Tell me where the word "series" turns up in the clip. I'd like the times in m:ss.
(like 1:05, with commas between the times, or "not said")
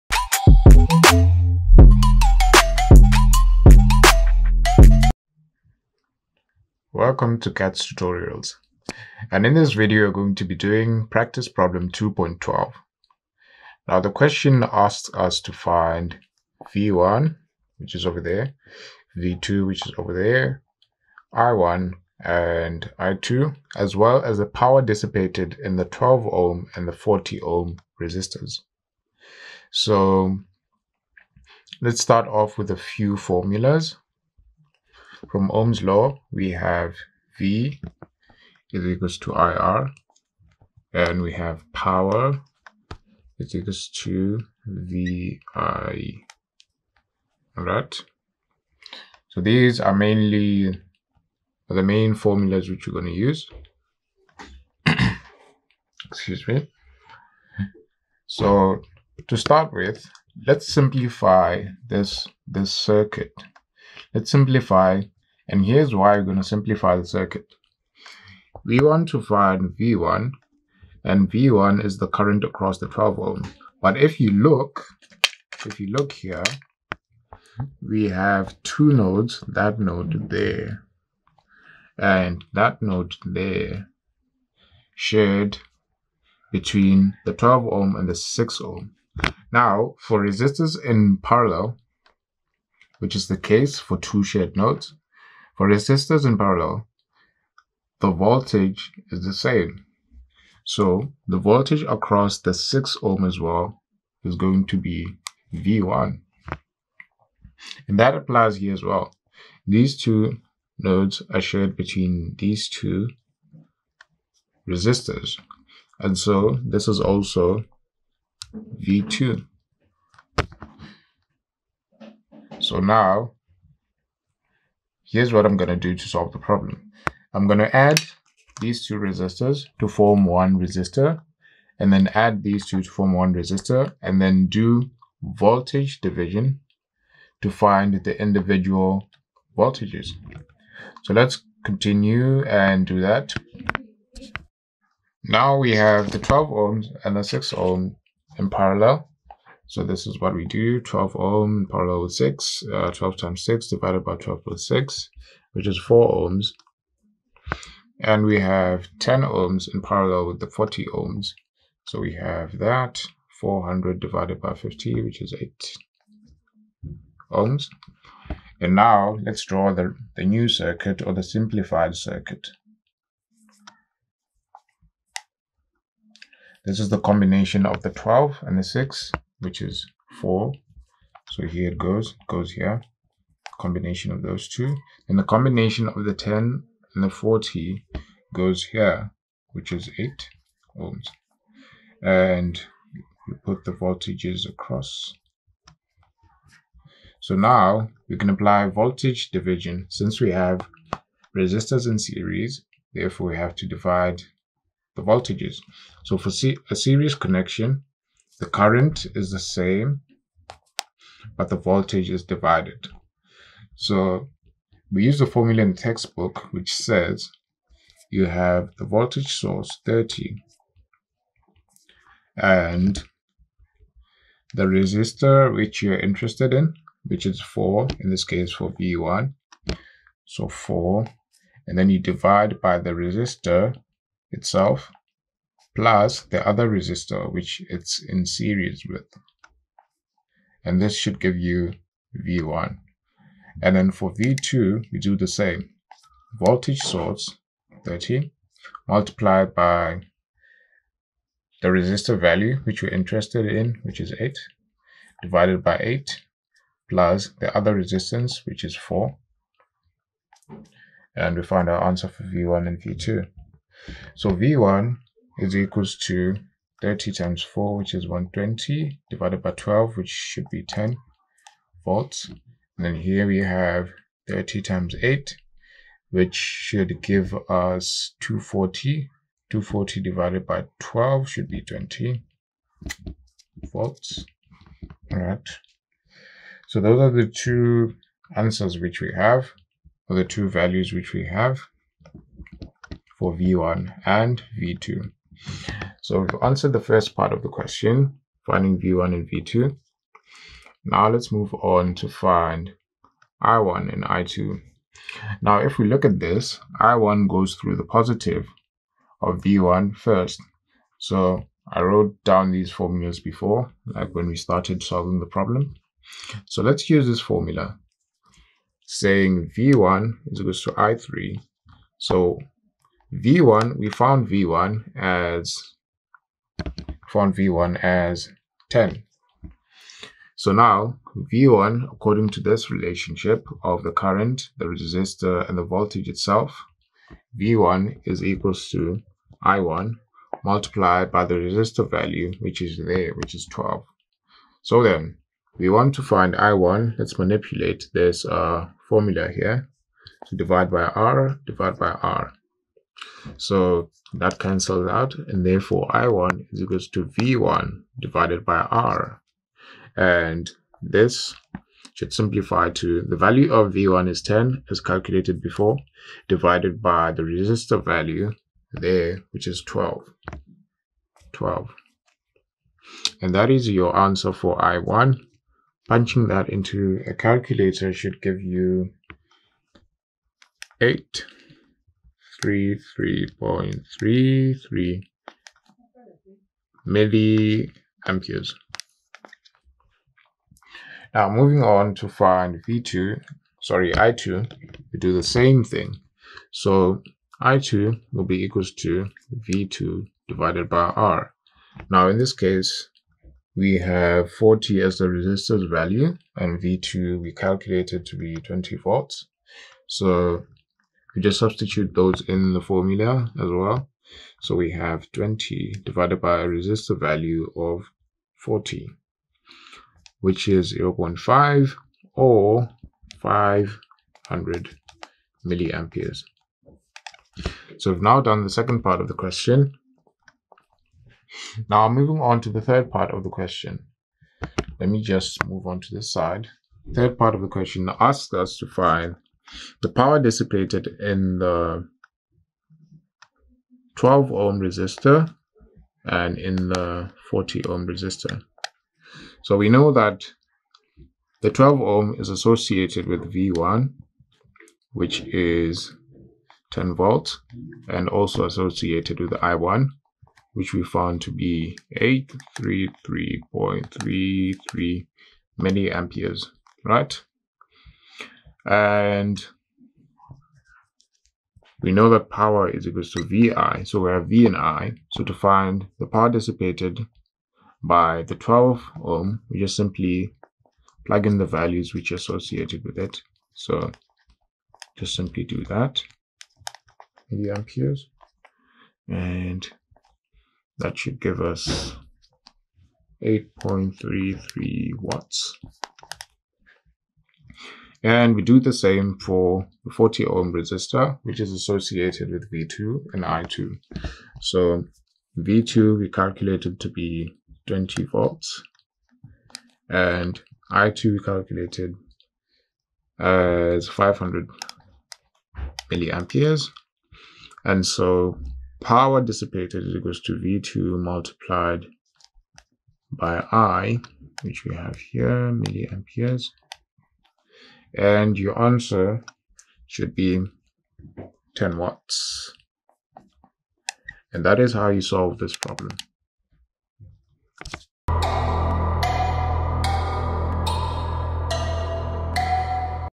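3:21, 3:26, 3:58.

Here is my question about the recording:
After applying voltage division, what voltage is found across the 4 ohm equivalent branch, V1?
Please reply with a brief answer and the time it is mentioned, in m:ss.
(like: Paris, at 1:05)
10 volts, at 4:30.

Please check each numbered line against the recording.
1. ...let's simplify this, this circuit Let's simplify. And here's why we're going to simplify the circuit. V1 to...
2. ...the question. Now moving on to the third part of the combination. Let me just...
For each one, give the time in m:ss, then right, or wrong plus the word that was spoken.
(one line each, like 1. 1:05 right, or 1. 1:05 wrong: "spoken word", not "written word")
1. 1:00 right
2. 7:09 wrong: "question", not "combination".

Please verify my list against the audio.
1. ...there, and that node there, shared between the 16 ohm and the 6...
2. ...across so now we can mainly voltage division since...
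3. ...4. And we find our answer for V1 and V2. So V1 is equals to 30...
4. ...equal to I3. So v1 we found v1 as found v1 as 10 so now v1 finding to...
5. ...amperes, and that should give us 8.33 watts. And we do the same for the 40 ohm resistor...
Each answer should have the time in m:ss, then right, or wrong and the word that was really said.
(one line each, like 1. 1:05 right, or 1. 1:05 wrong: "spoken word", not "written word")
1. 1:20 wrong: "12", not "16"
2. 3:14 wrong: "apply", not "mainly"
3. 4:18 right
4. 5:20 wrong: "according", not "finding"
5. 8:07 right.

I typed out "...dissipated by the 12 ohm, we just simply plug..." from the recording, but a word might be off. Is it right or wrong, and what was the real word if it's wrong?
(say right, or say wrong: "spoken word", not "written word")
right.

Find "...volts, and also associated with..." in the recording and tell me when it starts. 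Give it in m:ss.
7:36.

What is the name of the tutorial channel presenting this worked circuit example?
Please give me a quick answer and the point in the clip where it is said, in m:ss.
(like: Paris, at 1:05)
Khetz Tutorials, at 0:07.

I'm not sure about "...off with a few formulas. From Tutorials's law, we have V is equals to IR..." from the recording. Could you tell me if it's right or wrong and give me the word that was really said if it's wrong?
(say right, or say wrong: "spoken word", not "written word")
wrong: "Ohm", not "Tutorials".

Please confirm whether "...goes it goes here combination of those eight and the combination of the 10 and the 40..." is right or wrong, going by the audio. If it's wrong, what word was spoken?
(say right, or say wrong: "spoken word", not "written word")
wrong: "two", not "eight".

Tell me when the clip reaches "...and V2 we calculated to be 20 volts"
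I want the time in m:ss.
6:46.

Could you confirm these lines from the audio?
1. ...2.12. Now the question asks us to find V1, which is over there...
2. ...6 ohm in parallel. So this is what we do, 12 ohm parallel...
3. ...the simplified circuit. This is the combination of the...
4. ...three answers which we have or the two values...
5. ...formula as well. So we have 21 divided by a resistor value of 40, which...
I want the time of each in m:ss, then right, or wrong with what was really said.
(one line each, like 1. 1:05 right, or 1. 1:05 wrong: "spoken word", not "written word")
1. 0:11 right
2. 2:27 right
3. 2:51 right
4. 4:47 wrong: "two", not "three"
5. 6:52 wrong: "20", not "21".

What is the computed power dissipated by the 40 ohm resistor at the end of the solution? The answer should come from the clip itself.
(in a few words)
10 watts.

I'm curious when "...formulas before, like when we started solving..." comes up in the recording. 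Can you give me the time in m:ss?
5:12.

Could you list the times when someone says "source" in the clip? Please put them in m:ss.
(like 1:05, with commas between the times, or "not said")
3:39, 4:06.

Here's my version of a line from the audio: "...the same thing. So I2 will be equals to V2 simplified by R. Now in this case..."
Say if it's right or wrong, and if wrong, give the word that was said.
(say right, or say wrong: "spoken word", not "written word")
wrong: "divided", not "simplified".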